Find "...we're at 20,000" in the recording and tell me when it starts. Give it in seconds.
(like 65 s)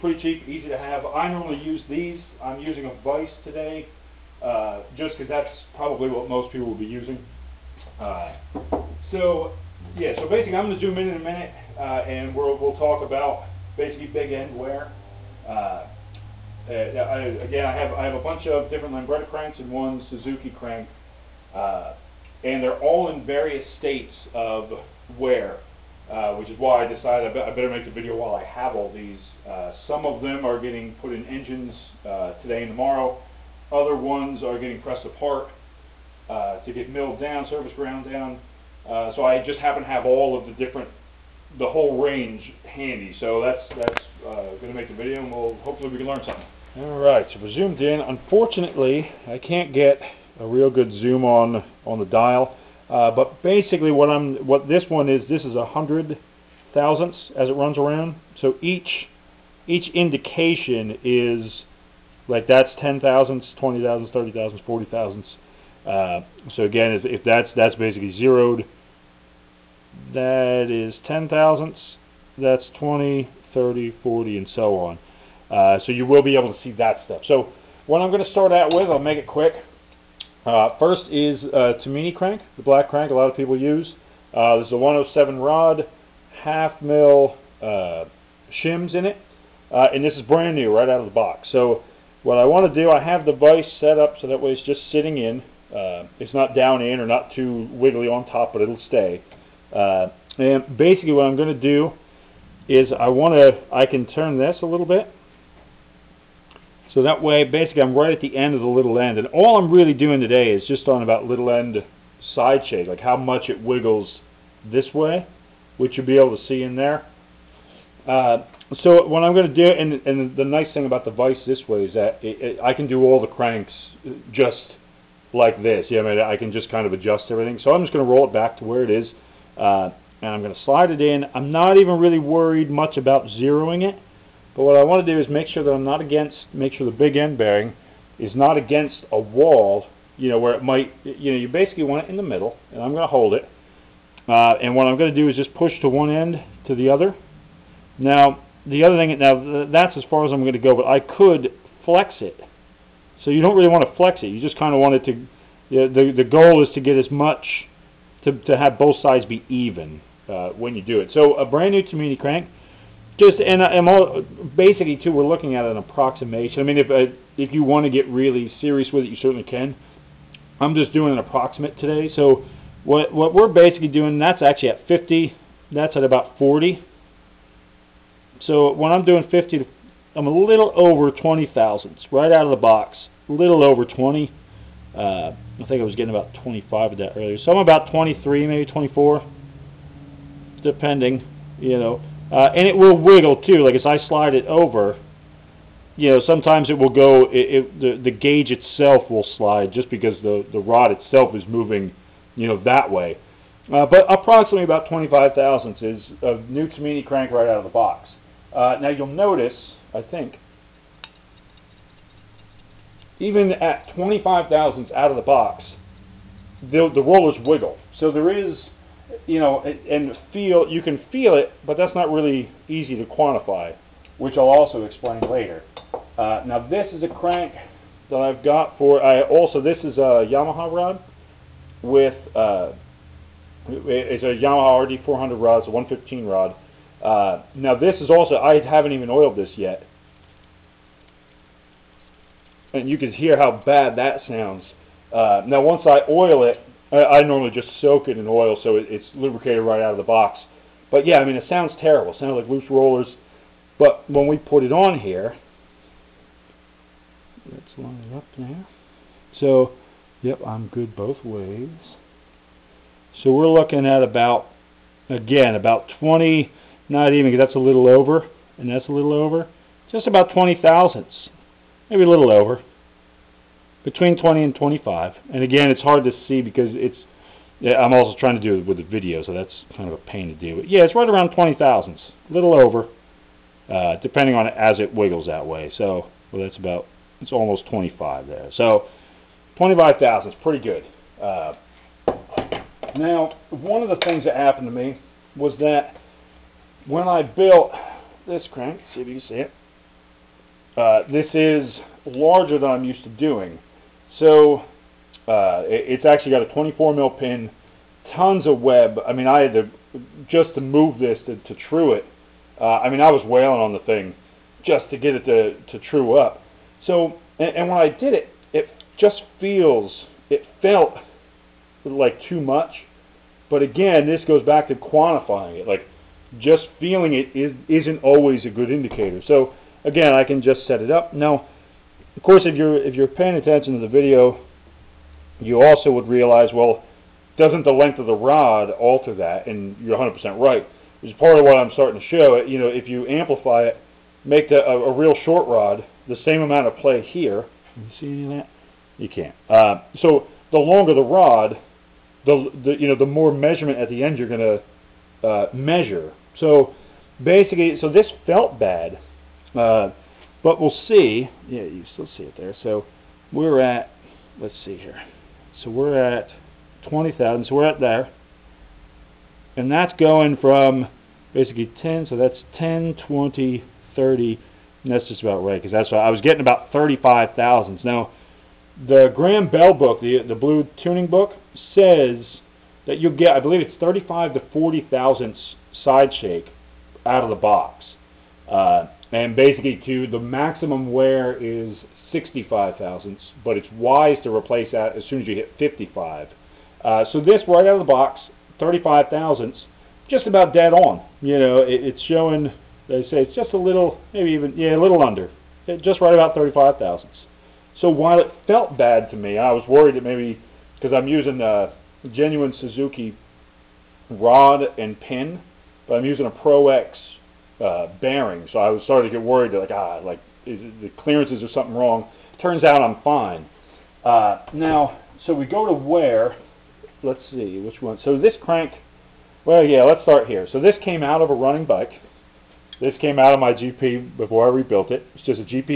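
365 s.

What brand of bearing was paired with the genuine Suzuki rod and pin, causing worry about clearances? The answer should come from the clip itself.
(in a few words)
Pro X.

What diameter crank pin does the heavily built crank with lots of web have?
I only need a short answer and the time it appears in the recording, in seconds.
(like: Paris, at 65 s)
24 mil, at 306 s.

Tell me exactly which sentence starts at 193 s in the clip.
Like as I slide it over, you know, sometimes it will go.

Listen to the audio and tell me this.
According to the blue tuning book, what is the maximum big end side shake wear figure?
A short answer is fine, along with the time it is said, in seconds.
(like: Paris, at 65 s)
65 thousandths, at 392 s.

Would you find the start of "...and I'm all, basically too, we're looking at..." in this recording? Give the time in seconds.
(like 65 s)
163 s.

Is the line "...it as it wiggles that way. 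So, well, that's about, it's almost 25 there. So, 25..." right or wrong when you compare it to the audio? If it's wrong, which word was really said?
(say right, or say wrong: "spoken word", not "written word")
right.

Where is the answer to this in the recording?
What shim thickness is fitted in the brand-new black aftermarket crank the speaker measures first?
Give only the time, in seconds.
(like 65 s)
86 s.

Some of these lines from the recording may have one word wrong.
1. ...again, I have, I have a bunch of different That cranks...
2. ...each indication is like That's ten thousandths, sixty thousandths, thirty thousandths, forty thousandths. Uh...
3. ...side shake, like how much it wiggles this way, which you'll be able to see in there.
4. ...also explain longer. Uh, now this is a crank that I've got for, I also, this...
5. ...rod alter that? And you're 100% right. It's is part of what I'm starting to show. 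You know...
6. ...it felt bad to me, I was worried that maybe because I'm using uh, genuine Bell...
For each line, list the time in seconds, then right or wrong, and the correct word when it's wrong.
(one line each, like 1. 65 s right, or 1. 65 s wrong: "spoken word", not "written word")
1. 17 s wrong: "Lambretta", not "That"
2. 59 s wrong: "twenty", not "sixty"
3. 112 s right
4. 224 s wrong: "later", not "longer"
5. 338 s right
6. 408 s wrong: "Suzuki", not "Bell".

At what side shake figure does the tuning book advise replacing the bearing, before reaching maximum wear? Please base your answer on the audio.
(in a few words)
55.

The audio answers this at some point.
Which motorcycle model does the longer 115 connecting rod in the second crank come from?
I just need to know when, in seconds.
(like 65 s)
234 s.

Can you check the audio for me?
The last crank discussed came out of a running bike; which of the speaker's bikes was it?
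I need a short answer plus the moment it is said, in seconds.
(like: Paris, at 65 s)
GP, at 433 s.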